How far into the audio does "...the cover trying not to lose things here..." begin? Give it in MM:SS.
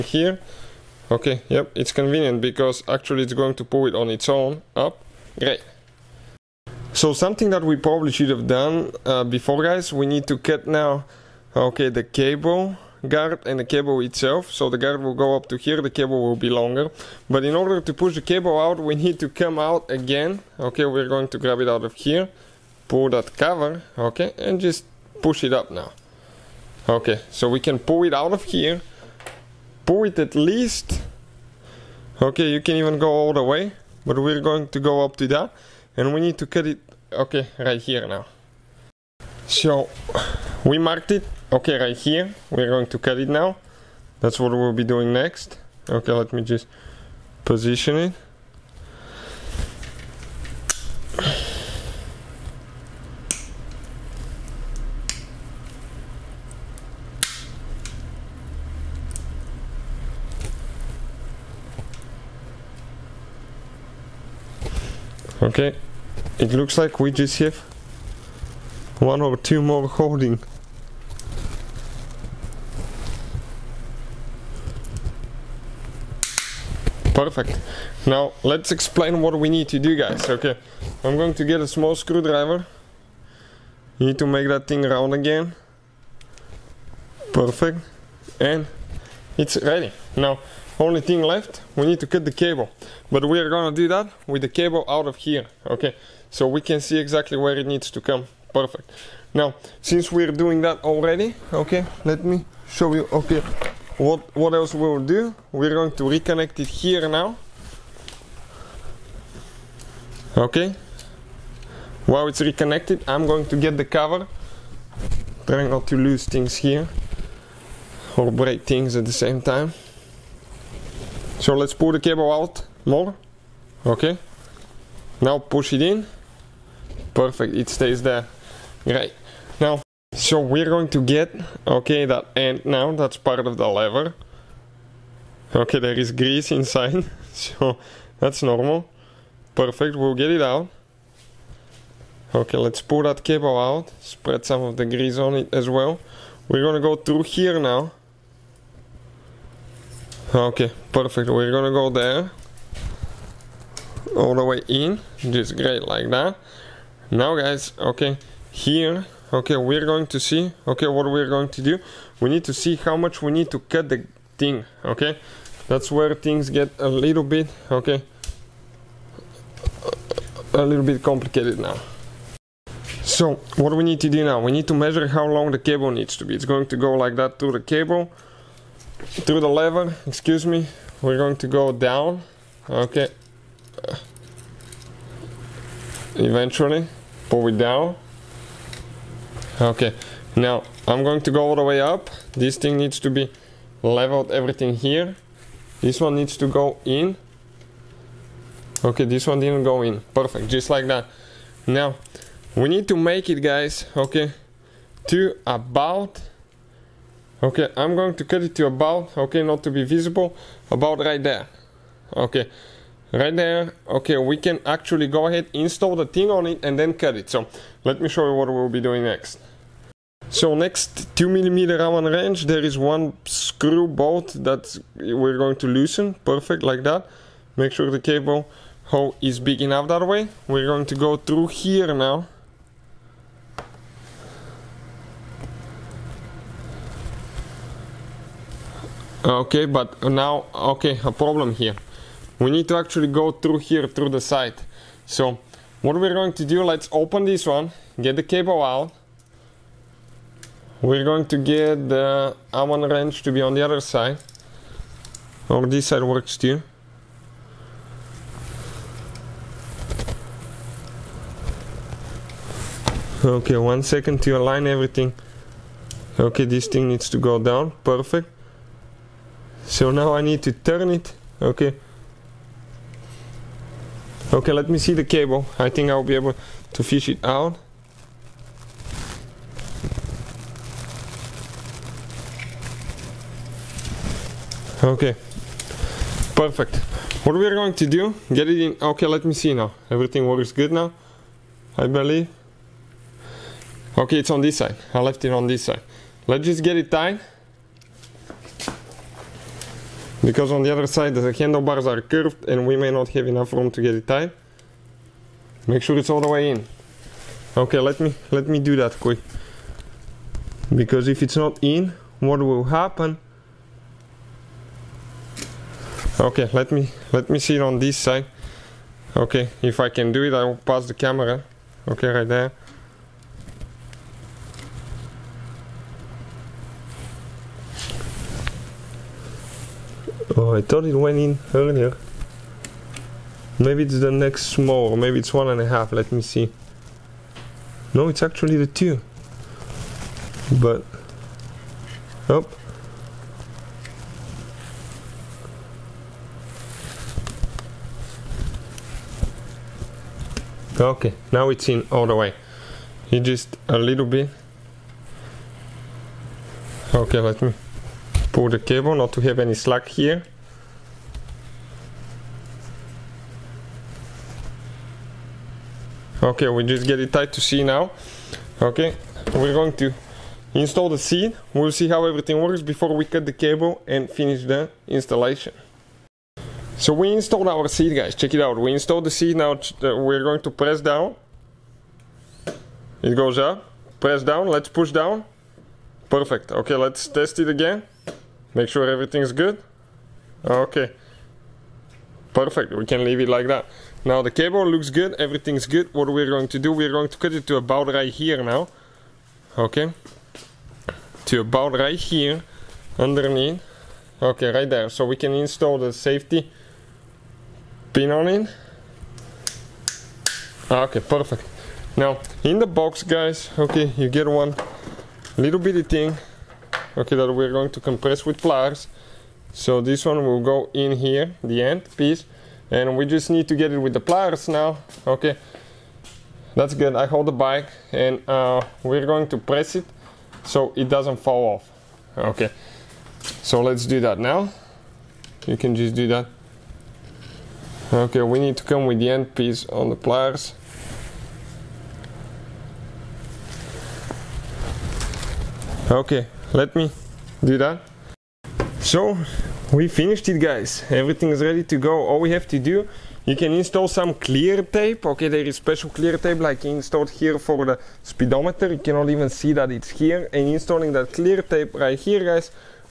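01:53.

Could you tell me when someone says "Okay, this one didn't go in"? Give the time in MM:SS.
03:18.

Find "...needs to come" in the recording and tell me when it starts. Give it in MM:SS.
01:37.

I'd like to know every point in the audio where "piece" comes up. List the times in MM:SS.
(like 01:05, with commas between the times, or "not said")
07:01, 07:19.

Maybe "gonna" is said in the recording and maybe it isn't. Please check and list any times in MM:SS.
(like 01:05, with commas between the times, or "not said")
01:33, 02:26, 02:31.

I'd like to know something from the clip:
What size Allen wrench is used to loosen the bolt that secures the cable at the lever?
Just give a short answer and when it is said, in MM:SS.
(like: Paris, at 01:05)
2 millimeter, at 03:41.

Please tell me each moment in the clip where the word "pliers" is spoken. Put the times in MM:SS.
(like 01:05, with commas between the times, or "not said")
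06:58, 07:04, 07:19.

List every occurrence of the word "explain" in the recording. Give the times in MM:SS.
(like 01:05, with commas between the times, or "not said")
01:18.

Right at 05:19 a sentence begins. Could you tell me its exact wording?
Okay, if I can do it, I will pass the camera.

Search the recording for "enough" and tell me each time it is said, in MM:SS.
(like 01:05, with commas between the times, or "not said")
03:49, 05:03.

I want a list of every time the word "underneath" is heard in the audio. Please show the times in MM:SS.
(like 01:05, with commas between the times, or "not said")
06:42.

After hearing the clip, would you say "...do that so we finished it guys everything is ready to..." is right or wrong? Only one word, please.
right.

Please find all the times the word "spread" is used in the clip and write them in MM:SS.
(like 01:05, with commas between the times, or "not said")
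02:24.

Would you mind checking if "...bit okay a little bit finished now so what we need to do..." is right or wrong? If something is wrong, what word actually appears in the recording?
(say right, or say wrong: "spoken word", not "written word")
wrong: "complicated", not "finished".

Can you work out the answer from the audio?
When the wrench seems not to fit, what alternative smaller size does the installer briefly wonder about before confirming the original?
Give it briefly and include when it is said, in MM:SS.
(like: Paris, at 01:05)
one and a half, at 05:35.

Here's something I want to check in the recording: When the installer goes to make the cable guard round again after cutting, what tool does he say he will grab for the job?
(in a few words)
small screwdriver.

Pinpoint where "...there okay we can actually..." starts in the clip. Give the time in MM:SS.
03:33.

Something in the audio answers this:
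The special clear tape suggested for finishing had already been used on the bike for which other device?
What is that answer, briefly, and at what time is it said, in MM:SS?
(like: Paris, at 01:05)
speedometer, at 07:38.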